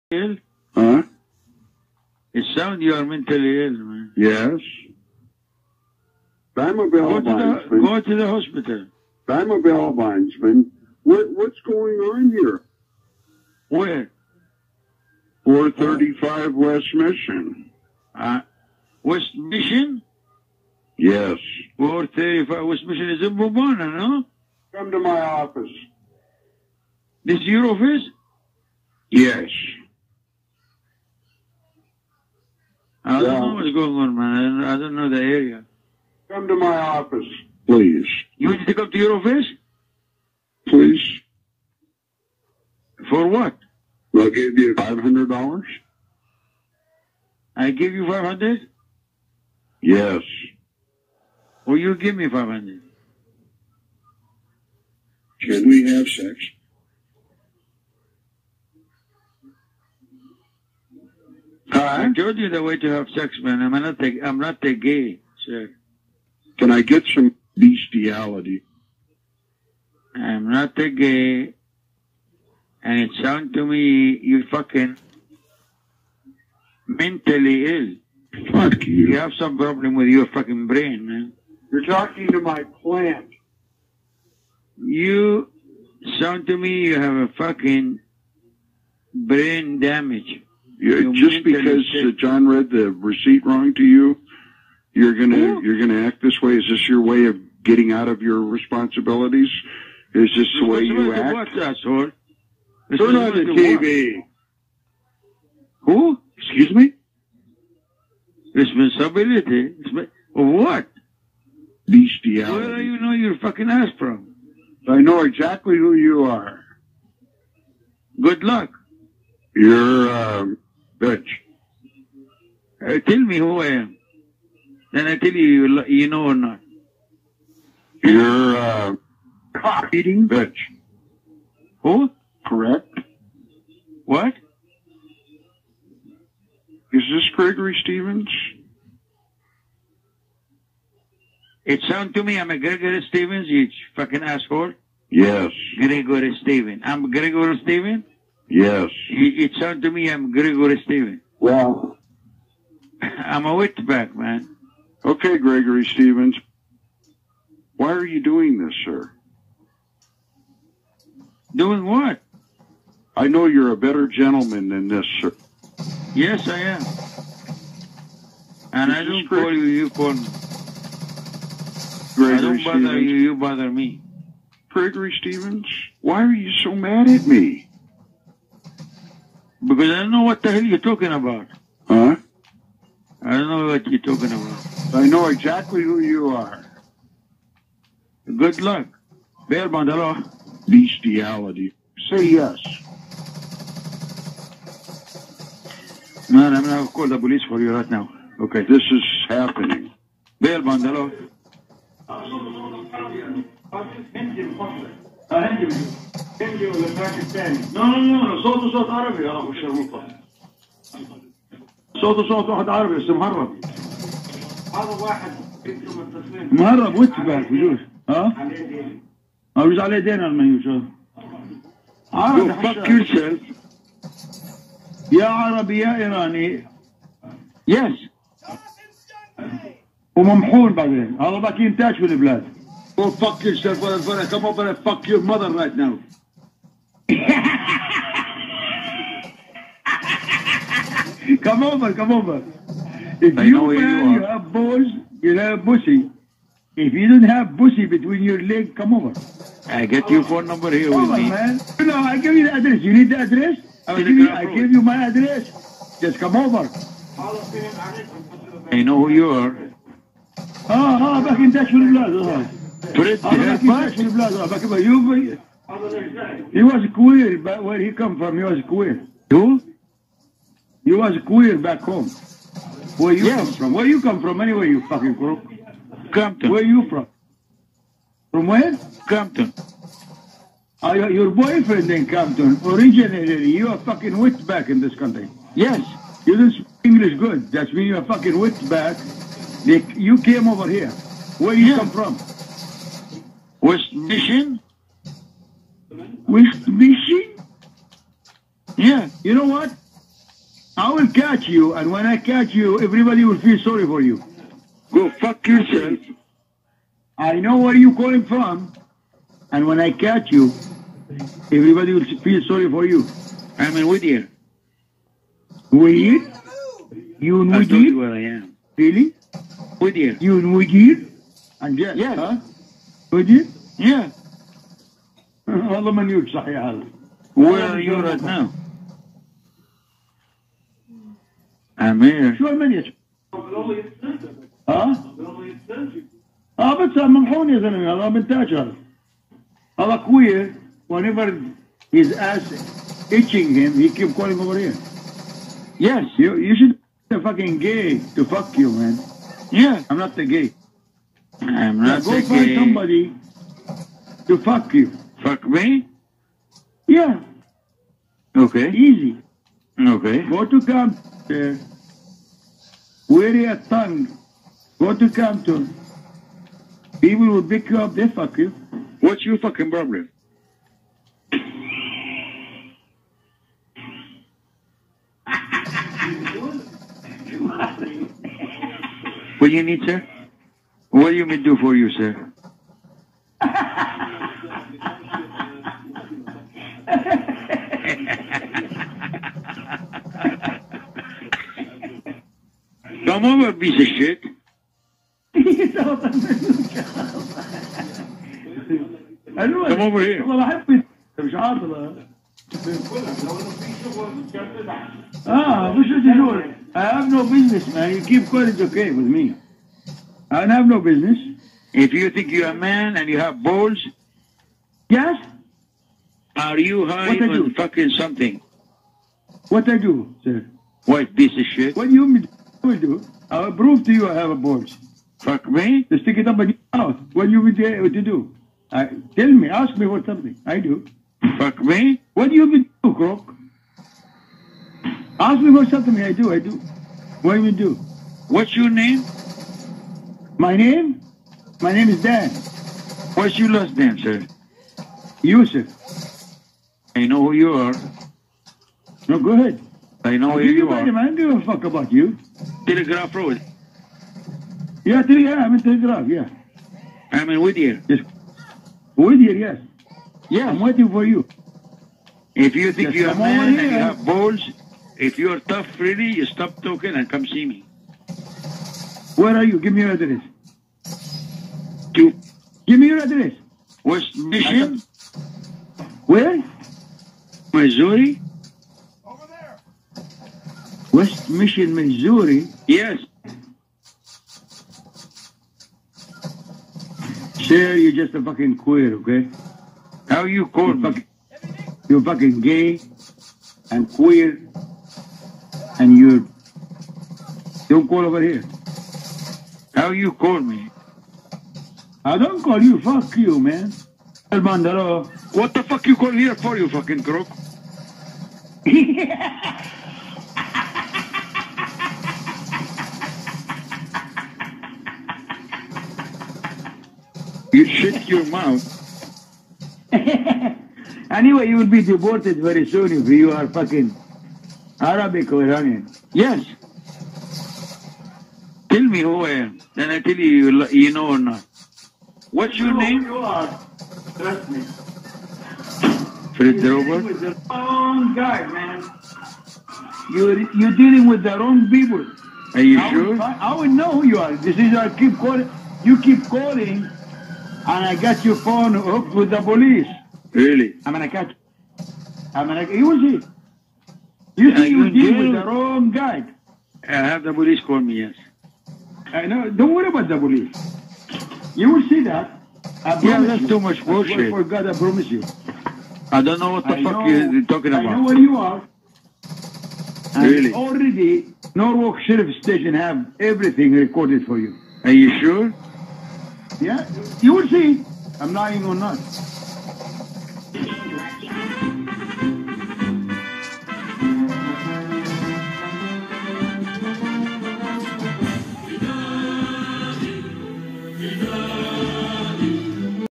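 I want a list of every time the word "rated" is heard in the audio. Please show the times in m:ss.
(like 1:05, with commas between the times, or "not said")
not said.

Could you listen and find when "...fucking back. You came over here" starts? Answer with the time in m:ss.
4:48.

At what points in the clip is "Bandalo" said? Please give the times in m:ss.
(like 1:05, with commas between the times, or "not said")
3:09, 3:20.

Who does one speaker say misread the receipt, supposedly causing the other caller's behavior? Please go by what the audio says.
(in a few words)
John.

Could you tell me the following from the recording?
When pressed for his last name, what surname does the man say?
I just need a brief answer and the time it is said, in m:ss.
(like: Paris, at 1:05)
Yusuf, at 7:25.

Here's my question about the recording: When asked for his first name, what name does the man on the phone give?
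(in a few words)
Dan.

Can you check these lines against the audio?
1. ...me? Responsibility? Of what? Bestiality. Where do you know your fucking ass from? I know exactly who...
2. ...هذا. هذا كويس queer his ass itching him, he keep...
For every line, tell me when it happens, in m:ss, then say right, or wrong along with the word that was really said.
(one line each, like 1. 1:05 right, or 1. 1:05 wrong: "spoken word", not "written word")
1. 1:46 right
2. 5:38 wrong: "whenever", not "queer".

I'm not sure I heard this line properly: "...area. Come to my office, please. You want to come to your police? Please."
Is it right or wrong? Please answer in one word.
wrong.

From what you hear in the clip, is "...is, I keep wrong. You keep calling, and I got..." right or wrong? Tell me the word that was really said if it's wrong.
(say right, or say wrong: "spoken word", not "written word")
wrong: "calling", not "wrong".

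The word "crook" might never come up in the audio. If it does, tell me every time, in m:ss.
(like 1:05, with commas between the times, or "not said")
4:35, 7:12, 8:27.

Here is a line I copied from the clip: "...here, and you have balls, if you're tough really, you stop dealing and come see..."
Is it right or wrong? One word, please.
wrong.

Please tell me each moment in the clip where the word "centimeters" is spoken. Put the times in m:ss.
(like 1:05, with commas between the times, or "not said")
not said.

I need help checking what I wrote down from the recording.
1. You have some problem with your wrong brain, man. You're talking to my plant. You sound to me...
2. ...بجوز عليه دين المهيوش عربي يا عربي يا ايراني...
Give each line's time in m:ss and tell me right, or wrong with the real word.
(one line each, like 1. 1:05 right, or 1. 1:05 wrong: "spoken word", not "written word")
1. 1:19 wrong: "fucking", not "wrong"
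2. 3:39 right.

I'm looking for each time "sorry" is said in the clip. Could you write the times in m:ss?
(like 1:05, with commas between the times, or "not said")
5:03, 5:12.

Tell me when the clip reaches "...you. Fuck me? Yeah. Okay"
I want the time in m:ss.
5:54.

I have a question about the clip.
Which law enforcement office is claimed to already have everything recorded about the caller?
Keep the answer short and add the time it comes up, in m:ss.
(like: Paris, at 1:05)
Norwalk Sheriff Station, at 9:31.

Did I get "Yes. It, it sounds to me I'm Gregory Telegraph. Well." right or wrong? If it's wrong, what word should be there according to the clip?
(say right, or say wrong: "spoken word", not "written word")
wrong: "Stevens", not "Telegraph".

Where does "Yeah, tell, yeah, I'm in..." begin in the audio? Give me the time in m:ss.
7:34.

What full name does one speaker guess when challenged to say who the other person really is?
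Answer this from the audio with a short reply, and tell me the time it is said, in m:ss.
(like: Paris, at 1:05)
Fred Drover, at 8:56.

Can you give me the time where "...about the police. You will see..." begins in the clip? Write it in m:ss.
9:19.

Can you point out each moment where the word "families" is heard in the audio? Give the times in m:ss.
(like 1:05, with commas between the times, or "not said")
not said.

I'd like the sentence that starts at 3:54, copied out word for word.
Come over and fuck your mother right now.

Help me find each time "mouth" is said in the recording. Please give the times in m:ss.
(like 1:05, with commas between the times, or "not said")
7:06, 8:38.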